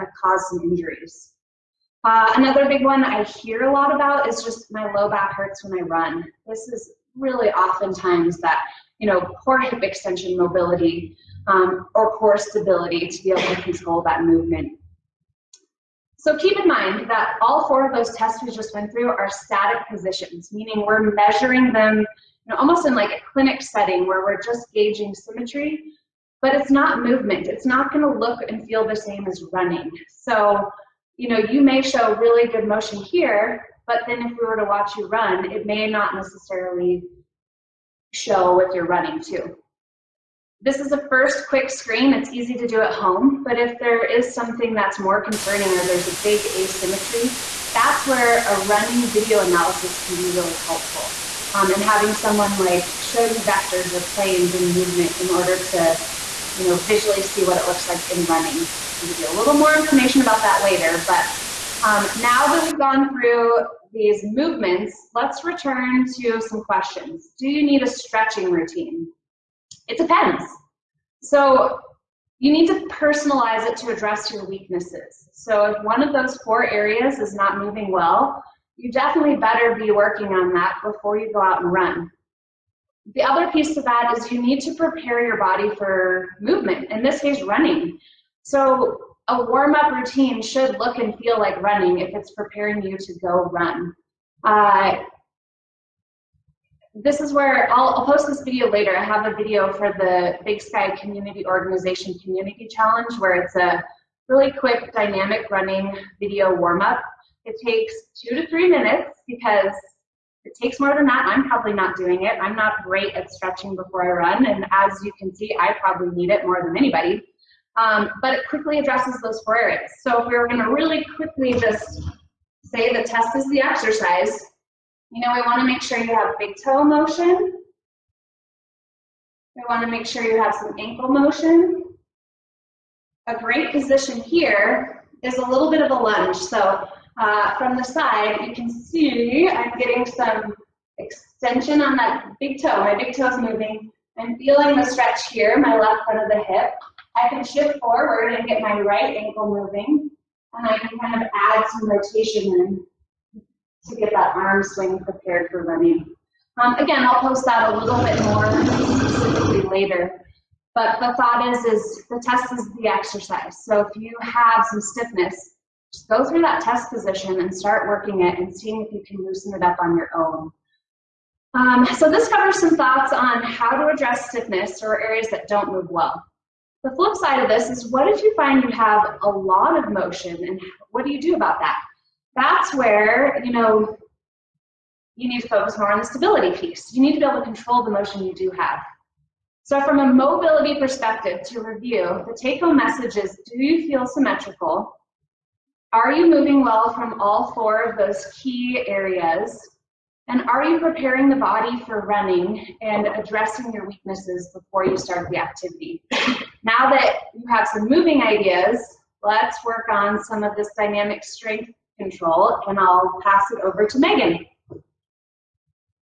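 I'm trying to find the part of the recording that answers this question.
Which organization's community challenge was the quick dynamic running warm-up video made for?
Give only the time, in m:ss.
1:40.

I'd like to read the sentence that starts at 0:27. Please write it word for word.
It's not going to look and feel the same as running.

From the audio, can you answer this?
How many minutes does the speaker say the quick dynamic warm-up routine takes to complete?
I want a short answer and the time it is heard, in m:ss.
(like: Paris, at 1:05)
2 to 3, at 1:48.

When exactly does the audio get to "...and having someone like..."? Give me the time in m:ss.
0:51.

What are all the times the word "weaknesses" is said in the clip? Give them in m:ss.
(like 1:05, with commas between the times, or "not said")
1:14, 3:23.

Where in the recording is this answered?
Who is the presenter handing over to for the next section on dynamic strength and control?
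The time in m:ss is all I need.
3:33.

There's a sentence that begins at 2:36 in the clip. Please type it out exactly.
Um, again, I'll post that a little bit more specifically later.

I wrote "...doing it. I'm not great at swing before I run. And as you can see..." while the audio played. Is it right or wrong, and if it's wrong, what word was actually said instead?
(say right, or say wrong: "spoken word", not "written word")
wrong: "stretching", not "swing".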